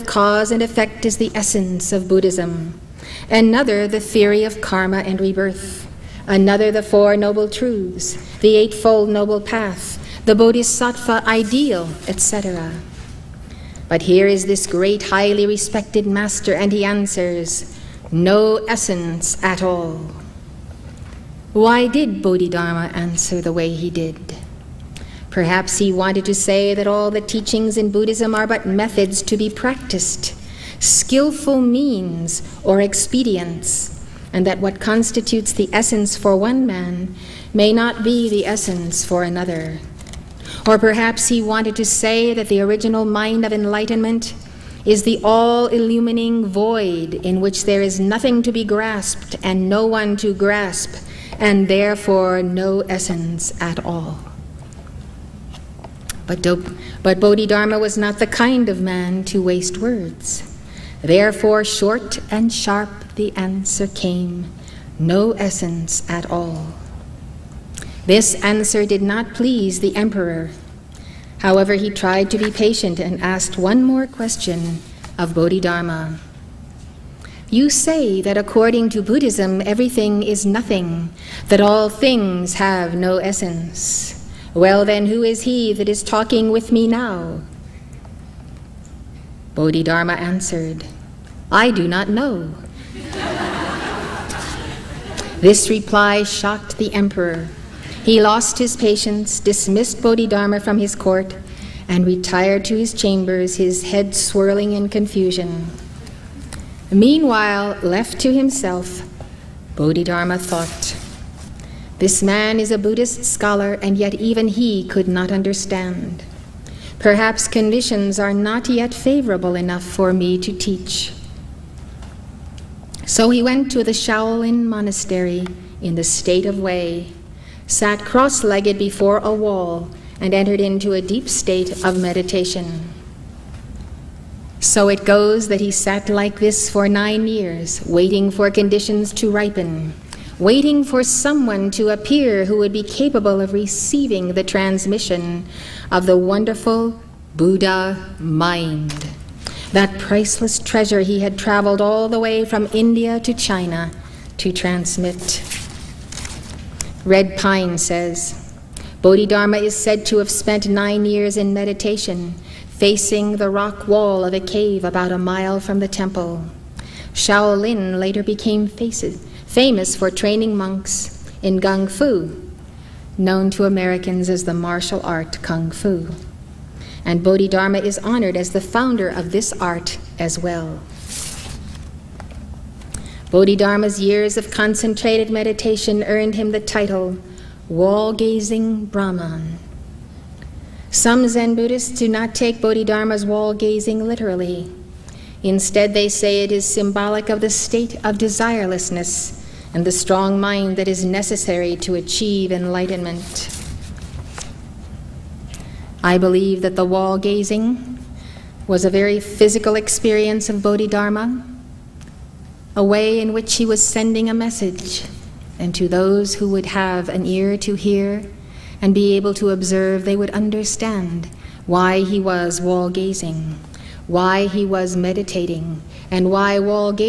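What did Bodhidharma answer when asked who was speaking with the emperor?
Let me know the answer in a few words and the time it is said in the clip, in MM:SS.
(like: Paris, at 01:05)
I do not know, at 01:31.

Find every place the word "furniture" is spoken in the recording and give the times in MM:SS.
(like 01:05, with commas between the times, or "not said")
not said.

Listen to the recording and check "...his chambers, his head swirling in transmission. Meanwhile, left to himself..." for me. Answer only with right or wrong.
wrong.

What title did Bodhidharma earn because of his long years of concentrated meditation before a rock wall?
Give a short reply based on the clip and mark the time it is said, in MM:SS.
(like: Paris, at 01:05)
Wall Gazing Brahman, at 03:07.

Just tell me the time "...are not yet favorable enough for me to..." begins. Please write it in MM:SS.
01:58.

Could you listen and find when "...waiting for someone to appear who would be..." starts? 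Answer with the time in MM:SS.
02:20.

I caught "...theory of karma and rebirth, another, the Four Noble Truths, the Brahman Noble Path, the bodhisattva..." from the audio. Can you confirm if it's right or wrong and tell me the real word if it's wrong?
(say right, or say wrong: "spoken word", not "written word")
wrong: "Eightfold", not "Brahman".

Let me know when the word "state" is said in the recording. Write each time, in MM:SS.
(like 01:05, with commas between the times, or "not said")
02:06, 02:11, 03:17.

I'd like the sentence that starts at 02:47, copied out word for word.
Shaolin later became faces, famous for training monks in Kung Fu, known to Americans as the martial art Kung Fu.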